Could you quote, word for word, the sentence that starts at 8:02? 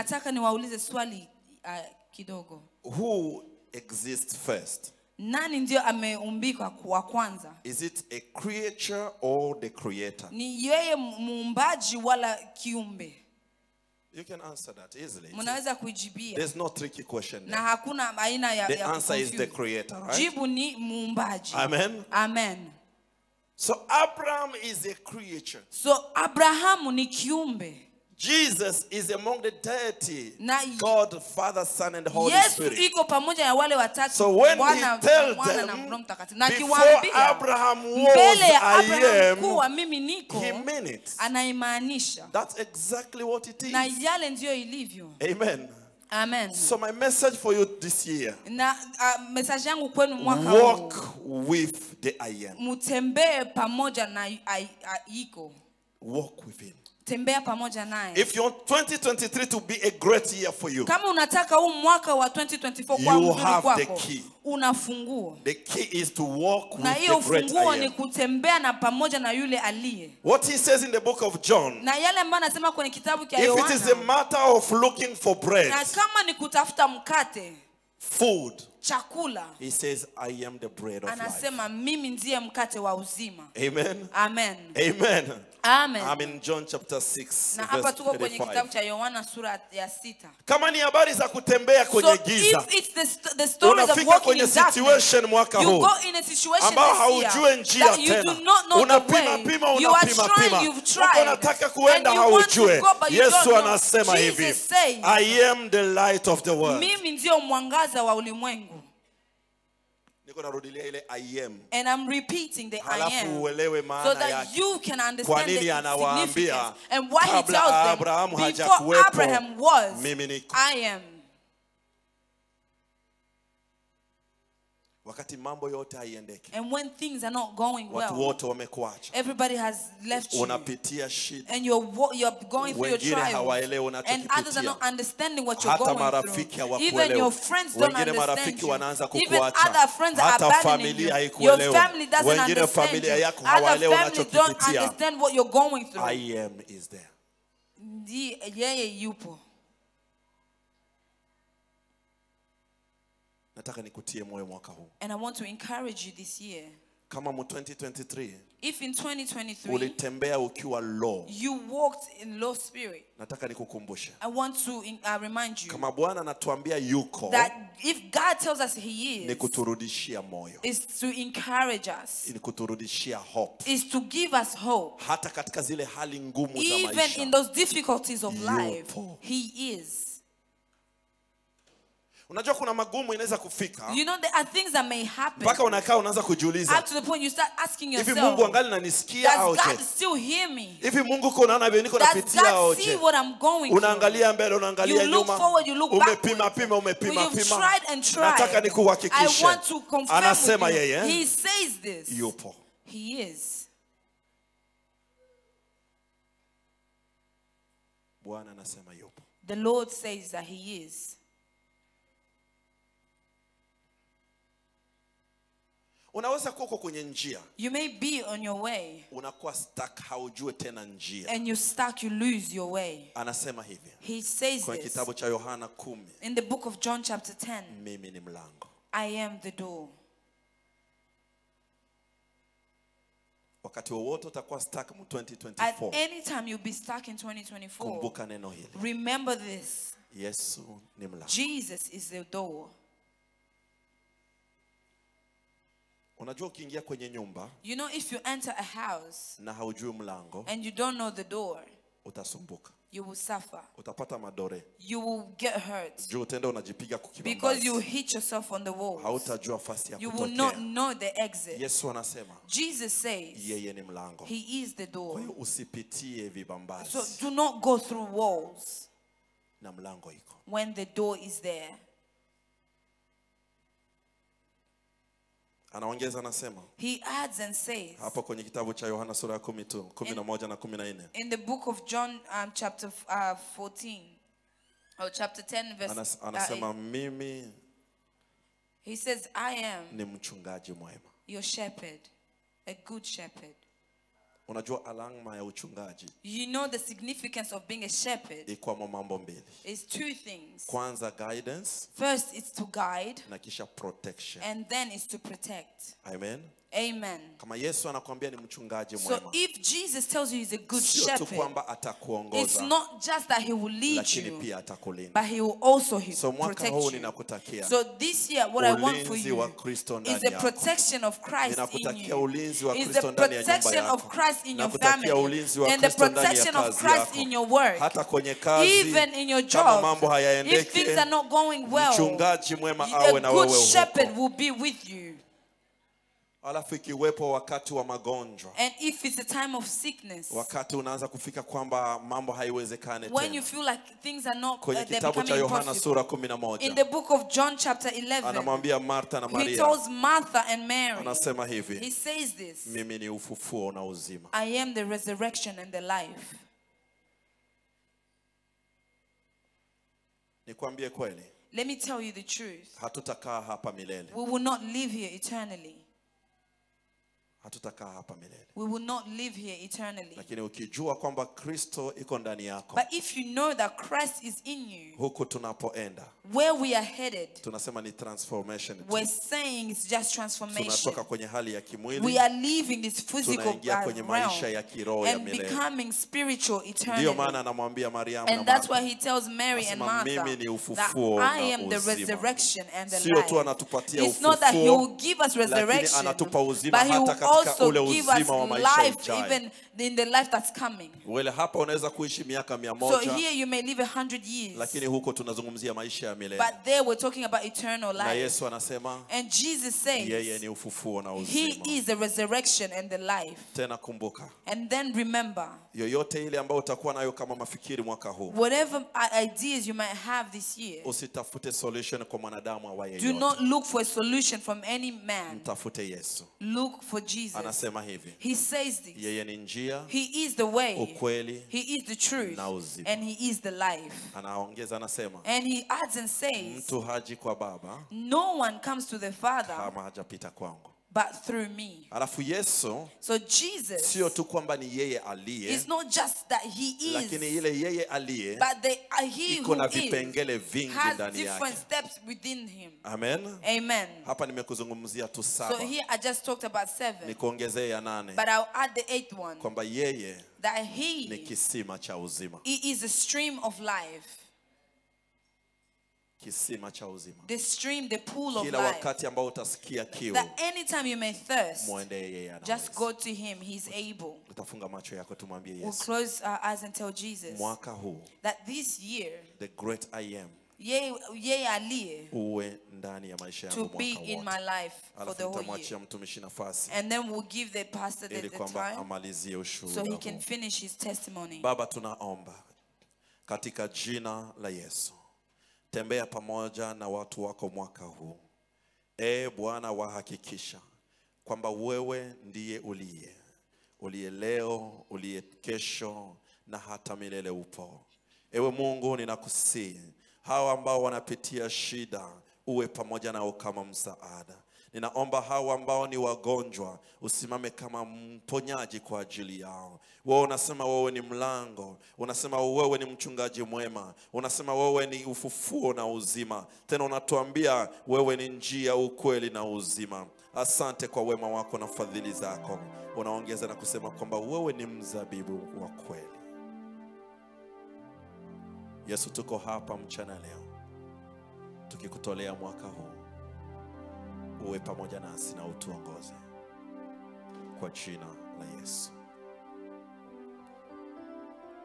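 Uwe ndani ya maisha yangu mwaka wote.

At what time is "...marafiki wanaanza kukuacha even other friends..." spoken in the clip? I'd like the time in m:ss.
2:18.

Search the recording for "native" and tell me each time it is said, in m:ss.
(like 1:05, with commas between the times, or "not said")
not said.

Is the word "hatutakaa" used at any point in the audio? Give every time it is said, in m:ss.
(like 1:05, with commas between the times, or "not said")
6:02, 6:07.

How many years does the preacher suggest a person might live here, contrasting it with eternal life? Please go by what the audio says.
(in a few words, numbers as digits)
100.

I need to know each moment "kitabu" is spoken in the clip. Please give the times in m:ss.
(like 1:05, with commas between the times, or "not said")
1:12, 1:28, 3:44, 4:38, 5:44.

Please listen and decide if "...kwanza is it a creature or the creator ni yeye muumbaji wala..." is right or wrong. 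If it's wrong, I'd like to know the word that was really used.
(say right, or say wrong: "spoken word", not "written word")
right.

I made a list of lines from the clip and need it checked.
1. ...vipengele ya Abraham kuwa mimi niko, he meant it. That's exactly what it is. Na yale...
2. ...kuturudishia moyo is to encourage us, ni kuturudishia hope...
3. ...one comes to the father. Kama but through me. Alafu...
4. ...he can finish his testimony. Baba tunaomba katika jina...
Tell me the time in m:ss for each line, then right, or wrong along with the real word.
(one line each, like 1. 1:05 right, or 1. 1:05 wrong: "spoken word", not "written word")
1. 0:37 wrong: "mbele", not "vipengele"
2. 2:49 right
3. 7:18 right
4. 8:09 right.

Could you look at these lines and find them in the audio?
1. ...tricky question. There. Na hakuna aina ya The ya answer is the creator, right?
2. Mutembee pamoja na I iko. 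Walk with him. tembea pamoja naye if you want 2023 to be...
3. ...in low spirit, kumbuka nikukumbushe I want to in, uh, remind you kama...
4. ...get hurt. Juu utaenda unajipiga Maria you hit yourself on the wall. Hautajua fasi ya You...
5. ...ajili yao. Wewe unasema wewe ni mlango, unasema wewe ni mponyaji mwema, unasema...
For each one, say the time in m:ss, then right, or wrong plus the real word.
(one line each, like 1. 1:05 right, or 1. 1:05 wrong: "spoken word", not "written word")
1. 0:16 right
2. 0:52 right
3. 2:42 wrong: "nataka", not "kumbuka"
4. 4:15 wrong: "Because", not "Maria"
5. 8:39 wrong: "mchungaji", not "mponyaji".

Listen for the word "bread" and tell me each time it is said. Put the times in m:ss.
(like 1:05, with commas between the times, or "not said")
1:15, 1:20.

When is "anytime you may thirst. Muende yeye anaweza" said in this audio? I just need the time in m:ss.
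7:50.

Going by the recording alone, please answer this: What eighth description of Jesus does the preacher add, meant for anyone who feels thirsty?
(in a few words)
a stream of life.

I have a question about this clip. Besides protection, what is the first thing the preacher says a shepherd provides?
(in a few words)
guidance.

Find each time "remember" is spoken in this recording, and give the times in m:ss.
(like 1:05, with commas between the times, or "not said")
3:58, 6:54.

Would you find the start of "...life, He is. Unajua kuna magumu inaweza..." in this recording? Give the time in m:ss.
2:58.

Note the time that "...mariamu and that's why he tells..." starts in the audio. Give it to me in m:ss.
6:27.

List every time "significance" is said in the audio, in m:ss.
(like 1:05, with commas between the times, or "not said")
1:56, 4:56.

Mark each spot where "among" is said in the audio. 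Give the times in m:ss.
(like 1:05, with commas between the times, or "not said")
0:29.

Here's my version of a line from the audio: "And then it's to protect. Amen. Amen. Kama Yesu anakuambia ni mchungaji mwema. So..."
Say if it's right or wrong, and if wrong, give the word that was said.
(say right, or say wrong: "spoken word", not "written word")
right.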